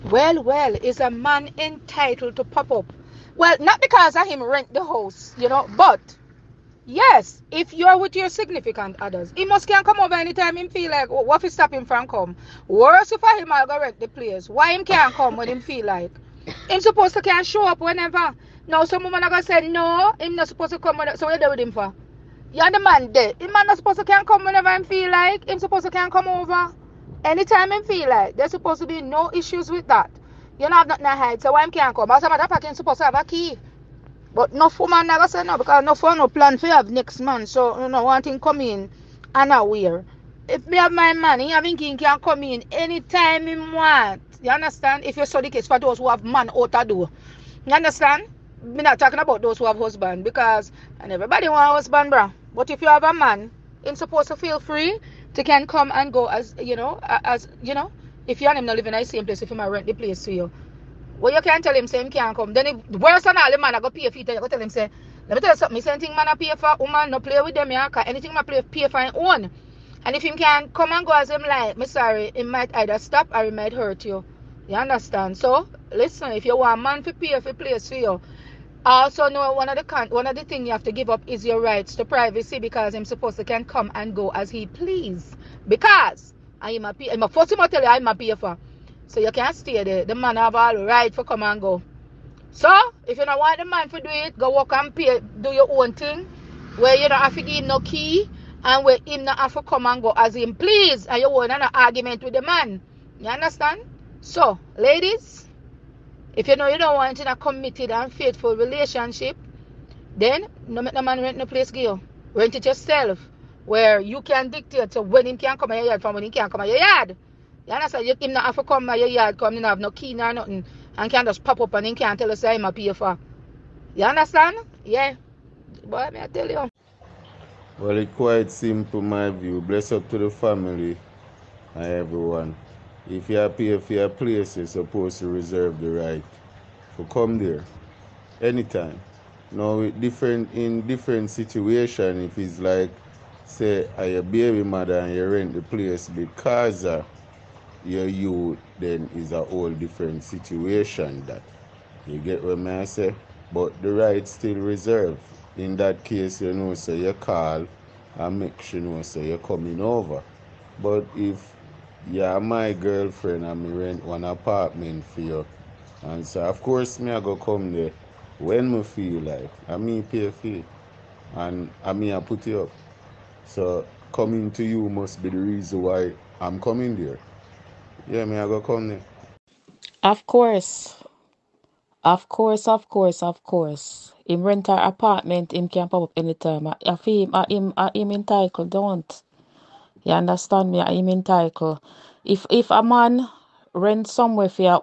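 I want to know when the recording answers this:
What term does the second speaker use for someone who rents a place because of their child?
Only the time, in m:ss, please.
2:24.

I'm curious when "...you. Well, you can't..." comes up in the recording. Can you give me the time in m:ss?
1:00.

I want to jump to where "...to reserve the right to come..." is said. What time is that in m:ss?
2:15.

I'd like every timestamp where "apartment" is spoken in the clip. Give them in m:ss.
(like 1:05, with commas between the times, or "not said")
2:44, 3:04.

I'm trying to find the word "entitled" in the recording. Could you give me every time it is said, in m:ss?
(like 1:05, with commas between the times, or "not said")
0:01, 3:08.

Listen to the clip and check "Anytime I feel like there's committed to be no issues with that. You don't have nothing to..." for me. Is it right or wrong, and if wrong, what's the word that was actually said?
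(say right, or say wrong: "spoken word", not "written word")
wrong: "supposed", not "committed".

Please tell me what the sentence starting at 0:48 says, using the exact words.
Me not talking about those who have husband because and everybody want husband, bruh.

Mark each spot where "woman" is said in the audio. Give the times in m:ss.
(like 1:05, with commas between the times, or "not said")
0:19, 0:34, 1:06.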